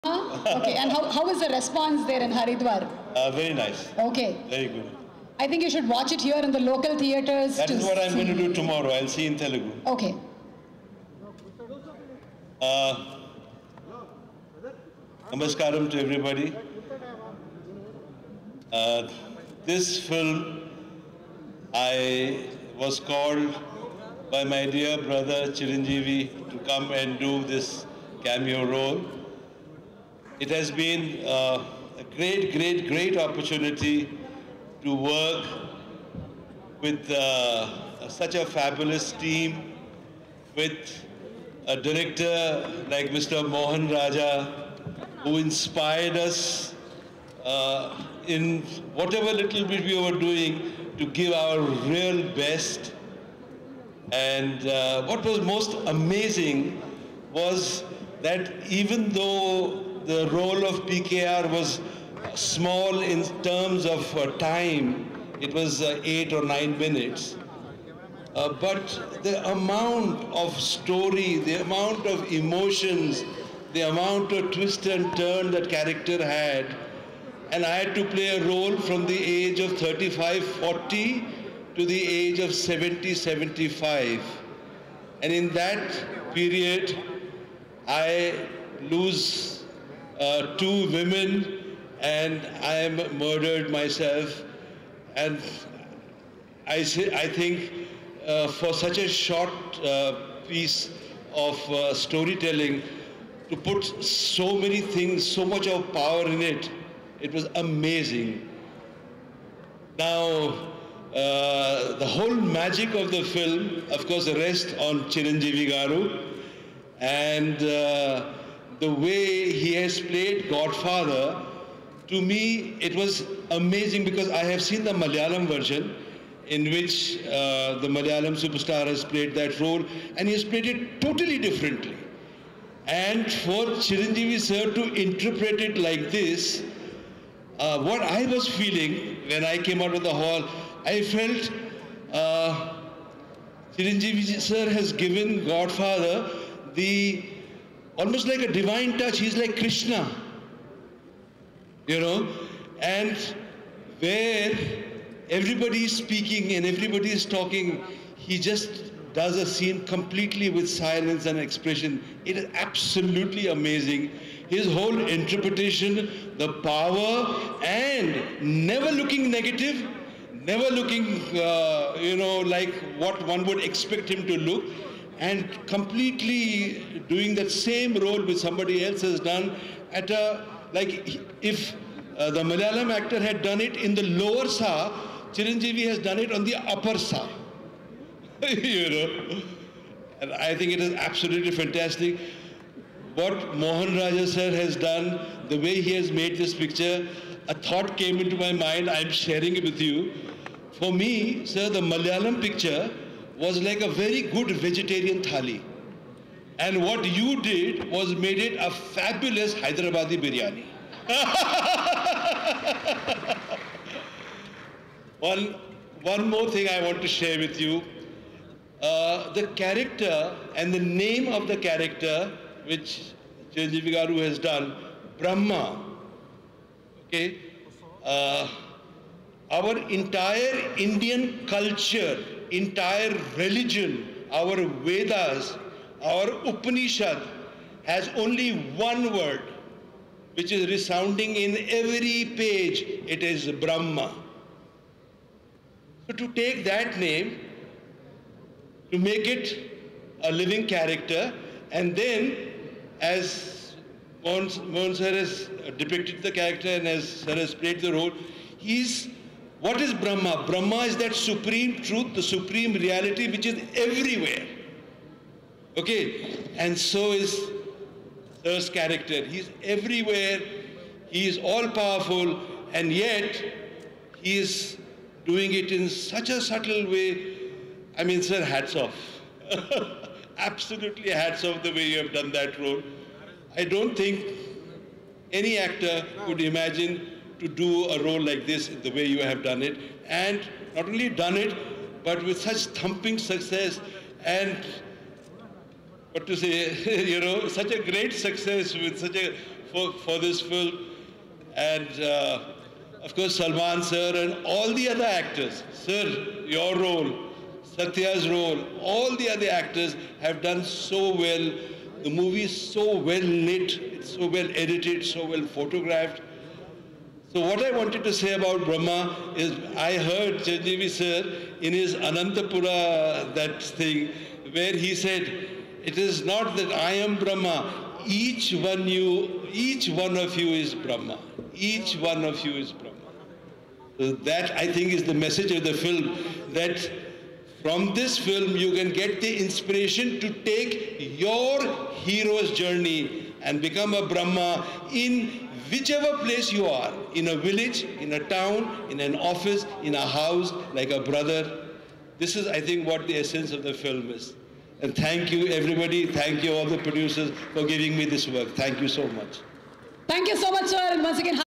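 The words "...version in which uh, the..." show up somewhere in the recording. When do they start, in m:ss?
2:05.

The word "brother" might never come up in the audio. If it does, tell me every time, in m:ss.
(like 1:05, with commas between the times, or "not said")
0:25, 5:50.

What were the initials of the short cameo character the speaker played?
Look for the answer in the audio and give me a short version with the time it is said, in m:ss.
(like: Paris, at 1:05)
PKR, at 1:00.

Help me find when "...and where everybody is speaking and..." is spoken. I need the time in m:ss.
2:32.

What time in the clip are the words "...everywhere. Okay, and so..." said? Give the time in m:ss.
4:23.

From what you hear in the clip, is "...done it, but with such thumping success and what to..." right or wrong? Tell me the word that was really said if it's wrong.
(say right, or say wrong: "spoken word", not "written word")
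right.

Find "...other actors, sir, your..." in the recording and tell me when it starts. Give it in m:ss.
5:04.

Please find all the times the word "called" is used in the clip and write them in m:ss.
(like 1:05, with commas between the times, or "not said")
0:22.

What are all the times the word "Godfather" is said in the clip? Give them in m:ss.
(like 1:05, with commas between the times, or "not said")
2:00, 2:25.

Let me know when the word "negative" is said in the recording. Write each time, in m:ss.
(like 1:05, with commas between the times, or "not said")
2:49.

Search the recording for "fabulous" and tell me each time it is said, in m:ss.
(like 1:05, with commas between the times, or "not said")
0:38, 3:28.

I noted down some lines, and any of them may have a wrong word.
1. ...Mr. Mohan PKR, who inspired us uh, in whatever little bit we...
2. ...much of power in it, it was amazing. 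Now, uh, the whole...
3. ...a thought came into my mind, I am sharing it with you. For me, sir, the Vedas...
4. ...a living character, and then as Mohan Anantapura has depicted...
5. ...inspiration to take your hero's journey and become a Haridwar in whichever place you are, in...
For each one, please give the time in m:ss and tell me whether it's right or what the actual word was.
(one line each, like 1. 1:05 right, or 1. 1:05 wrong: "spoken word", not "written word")
1. 0:43 wrong: "Raja", not "PKR"
2. 1:45 right
3. 3:17 wrong: "Malayalam", not "Vedas"
4. 4:10 wrong: "Sir", not "Anantapura"
5. 5:39 wrong: "Brahma", not "Haridwar".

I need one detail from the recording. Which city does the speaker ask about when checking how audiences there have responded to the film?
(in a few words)
Haridwar.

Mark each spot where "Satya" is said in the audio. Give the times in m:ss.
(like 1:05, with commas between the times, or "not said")
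5:07.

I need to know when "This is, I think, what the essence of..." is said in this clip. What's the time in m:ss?
5:52.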